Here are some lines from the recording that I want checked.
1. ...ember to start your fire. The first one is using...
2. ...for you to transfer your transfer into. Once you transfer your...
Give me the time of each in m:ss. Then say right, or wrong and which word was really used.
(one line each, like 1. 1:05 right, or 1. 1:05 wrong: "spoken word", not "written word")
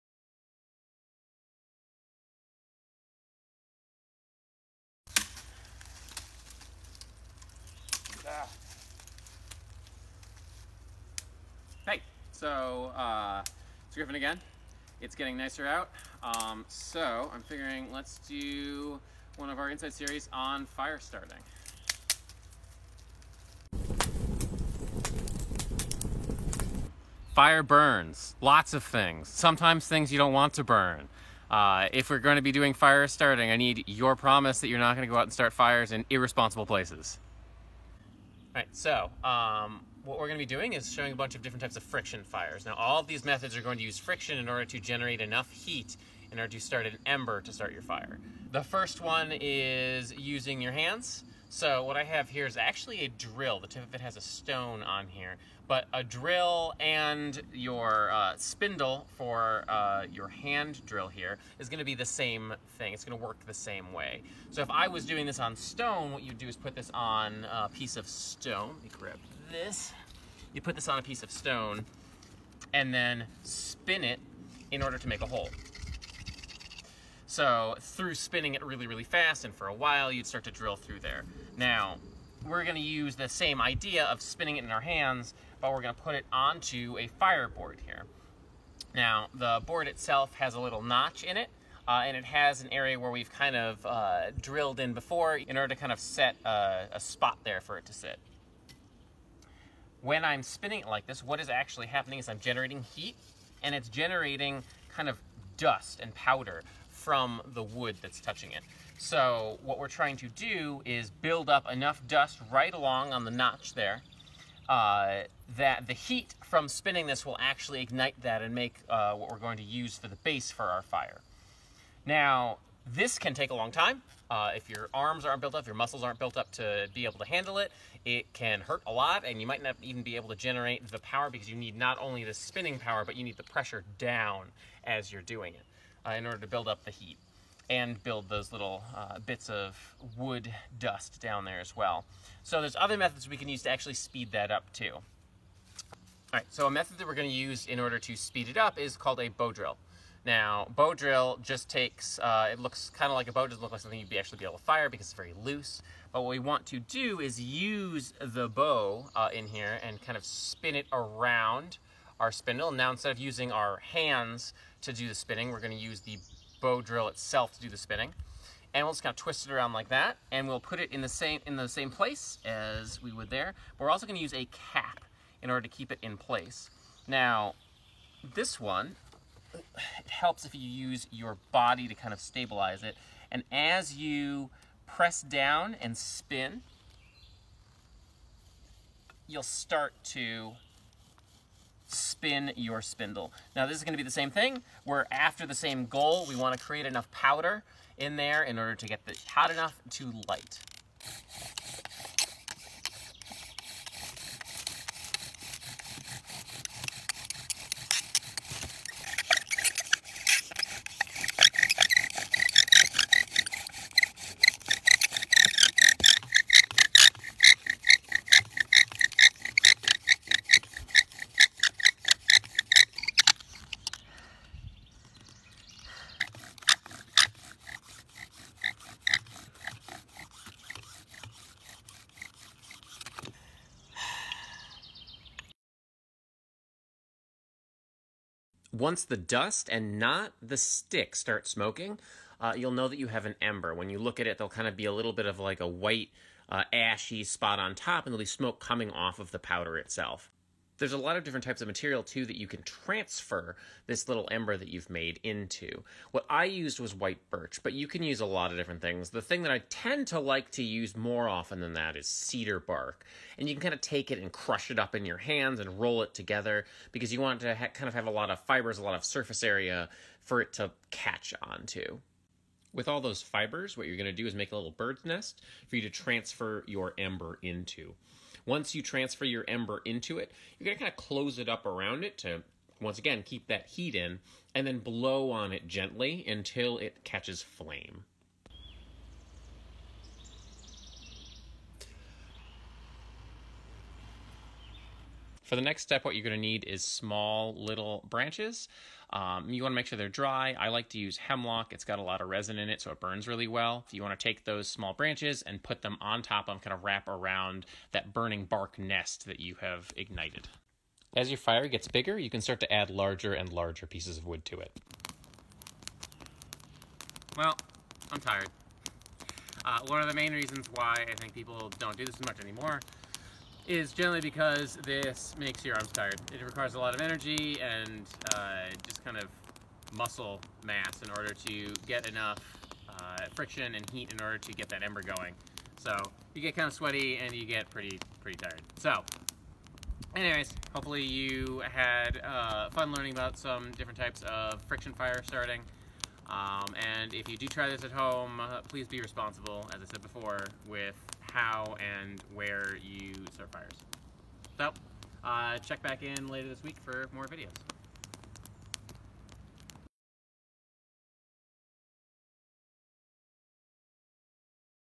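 1. 0:47 right
2. 4:35 wrong: "ember", not "transfer".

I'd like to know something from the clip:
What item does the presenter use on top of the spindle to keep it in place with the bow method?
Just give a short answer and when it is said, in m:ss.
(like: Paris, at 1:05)
A cap, at 2:54.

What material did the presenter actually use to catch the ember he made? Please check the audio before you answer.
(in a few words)
White birch.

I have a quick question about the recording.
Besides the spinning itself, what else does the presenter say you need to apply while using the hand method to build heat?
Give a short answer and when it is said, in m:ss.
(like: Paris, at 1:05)
Pressure down, at 2:13.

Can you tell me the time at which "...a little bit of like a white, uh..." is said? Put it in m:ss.
4:04.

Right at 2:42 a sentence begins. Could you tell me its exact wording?
Now instead of using our hands to do the spinning, we're gonna use the bow drill itself to do the spinning.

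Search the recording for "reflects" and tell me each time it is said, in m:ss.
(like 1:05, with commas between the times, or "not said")
not said.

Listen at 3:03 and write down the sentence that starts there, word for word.
And as you press down and spin, you'll start to spin your spindle.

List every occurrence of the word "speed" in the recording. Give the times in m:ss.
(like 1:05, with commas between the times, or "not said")
2:23, 2:28.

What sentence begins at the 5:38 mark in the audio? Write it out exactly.
So anyways, hopefully you had uh, fun learning about some different types of friction fire starting.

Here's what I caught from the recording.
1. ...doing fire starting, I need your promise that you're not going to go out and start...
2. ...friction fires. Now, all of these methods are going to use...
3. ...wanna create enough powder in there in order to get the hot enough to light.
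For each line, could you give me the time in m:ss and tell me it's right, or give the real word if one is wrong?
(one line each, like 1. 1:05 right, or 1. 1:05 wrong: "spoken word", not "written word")
1. 0:32 right
2. 0:41 right
3. 3:16 right.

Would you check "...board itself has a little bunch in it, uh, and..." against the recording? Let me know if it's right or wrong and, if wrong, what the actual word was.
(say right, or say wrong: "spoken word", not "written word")
wrong: "notch", not "bunch".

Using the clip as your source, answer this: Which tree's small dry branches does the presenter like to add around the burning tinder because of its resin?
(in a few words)
Hemlock.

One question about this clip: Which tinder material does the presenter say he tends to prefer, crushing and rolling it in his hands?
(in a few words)
Cedar bark.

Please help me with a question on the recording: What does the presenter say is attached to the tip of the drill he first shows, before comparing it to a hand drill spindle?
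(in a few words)
A stone.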